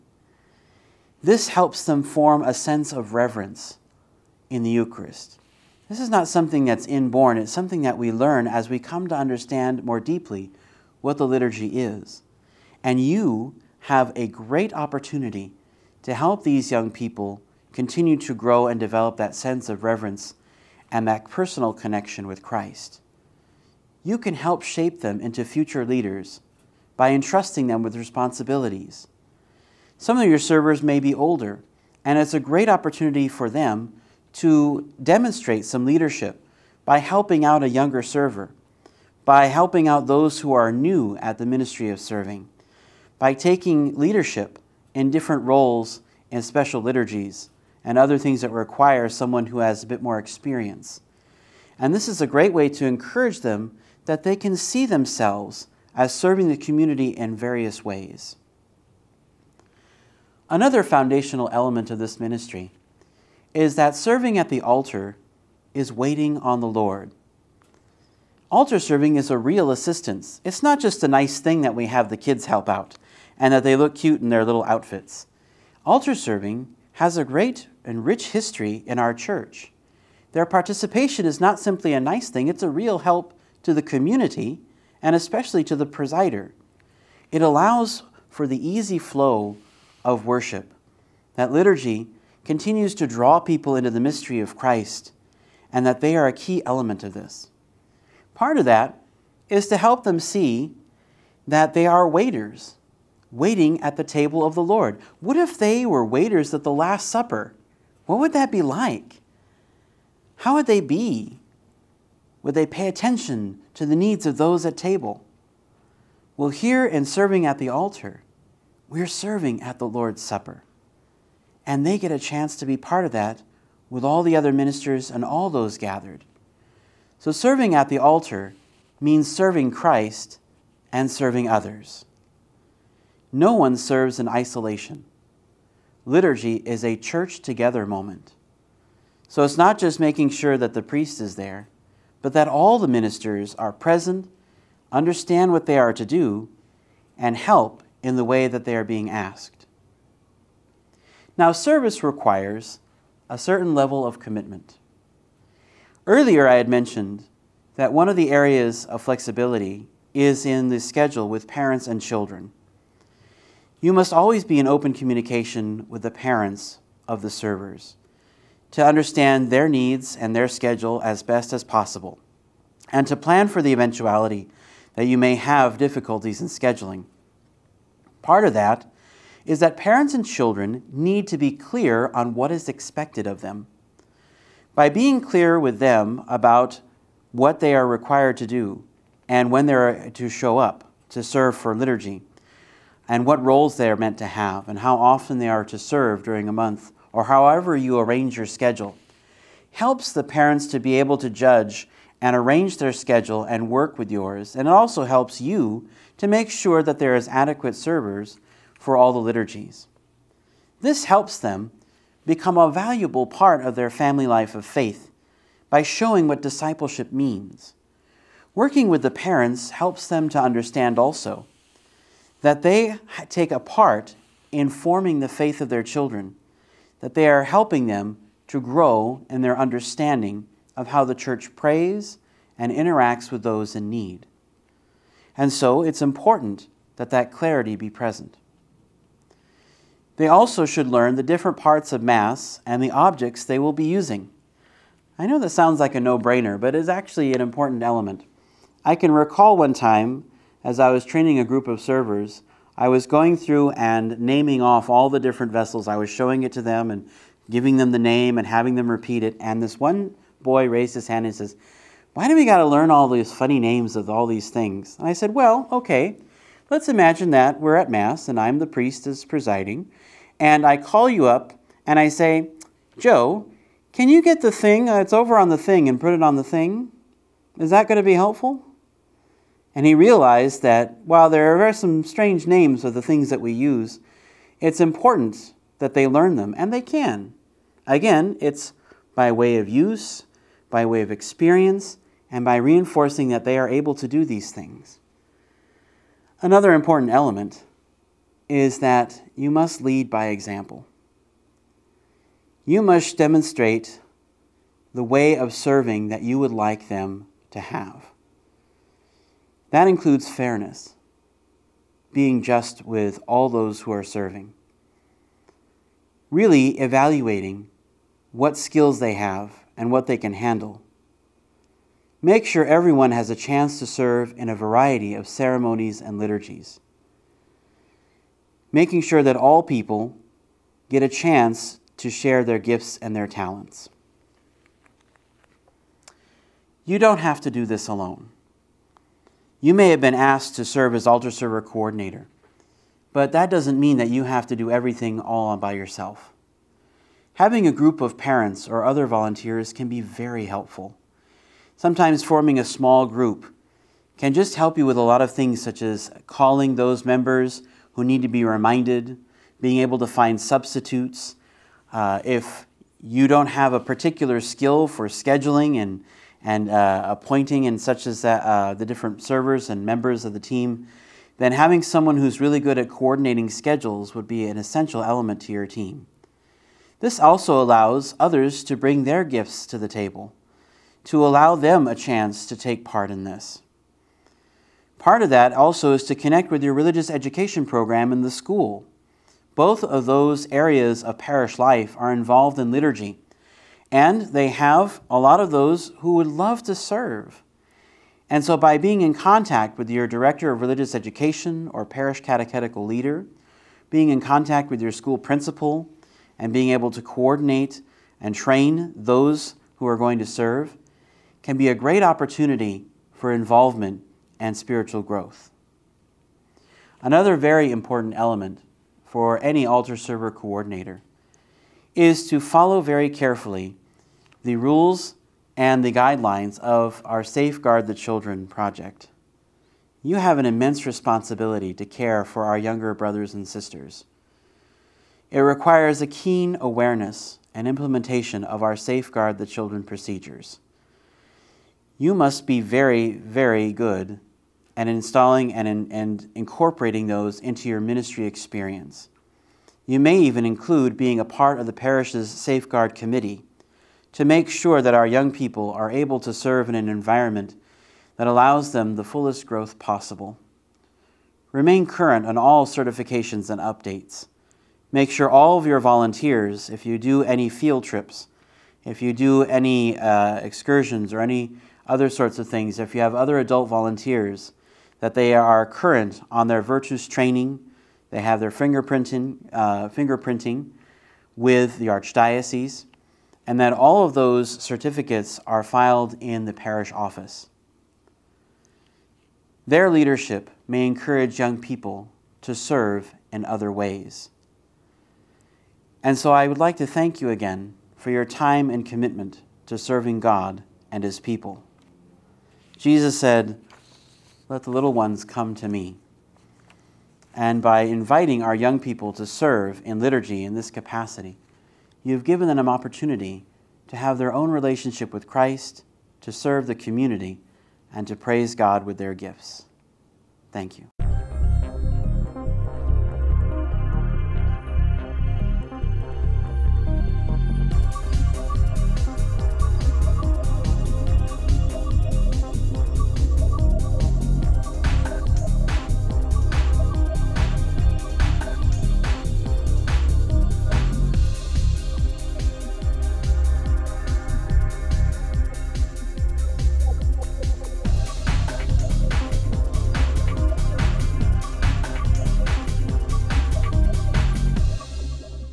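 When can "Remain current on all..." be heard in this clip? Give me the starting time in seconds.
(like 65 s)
461 s.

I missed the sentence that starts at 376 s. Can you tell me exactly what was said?
This also allows others to bring their gifts to the table, to allow them a chance to take part in this.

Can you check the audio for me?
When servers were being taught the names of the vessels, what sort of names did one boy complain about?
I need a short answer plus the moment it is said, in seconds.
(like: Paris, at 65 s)
Funny names, at 263 s.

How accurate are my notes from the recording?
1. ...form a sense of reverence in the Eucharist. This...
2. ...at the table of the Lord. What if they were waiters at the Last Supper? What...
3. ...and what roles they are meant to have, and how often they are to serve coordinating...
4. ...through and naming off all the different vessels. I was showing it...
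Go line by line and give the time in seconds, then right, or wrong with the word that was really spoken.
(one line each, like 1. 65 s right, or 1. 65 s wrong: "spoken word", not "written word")
1. 2 s right
2. 103 s right
3. 193 s wrong: "during", not "coordinating"
4. 253 s right.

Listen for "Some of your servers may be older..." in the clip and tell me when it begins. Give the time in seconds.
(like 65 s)
29 s.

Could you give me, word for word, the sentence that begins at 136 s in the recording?
Liturgy is a church together moment.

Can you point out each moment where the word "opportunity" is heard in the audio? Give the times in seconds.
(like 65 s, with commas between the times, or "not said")
14 s, 32 s, 412 s, 512 s.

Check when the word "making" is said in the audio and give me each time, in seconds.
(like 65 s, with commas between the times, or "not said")
139 s, 328 s.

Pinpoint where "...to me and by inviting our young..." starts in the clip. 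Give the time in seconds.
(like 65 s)
505 s.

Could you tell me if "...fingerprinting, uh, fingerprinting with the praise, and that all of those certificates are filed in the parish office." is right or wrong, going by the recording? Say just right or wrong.
wrong.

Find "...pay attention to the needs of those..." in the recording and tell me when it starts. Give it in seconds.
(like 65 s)
112 s.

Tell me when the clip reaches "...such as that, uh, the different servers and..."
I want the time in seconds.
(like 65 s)
367 s.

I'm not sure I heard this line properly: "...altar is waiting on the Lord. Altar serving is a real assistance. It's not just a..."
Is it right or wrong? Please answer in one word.
right.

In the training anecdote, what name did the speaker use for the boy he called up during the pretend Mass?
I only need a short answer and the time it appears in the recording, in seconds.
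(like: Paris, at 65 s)
Joe, at 272 s.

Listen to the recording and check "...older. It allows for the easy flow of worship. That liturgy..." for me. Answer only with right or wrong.
wrong.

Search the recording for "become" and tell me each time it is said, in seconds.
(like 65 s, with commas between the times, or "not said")
212 s.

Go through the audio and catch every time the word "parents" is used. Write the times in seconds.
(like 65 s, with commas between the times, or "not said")
161 s, 166 s, 179 s, 200 s, 219 s, 348 s.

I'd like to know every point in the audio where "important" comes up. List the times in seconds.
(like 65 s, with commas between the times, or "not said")
236 s, 247 s, 284 s, 296 s, 417 s.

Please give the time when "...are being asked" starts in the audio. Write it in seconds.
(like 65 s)
148 s.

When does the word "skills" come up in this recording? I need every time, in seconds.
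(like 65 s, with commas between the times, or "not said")
318 s, 364 s.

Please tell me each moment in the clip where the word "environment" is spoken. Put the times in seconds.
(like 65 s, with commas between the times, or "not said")
456 s.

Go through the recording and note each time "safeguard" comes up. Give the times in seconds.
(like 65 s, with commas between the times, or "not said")
427 s, 438 s, 452 s.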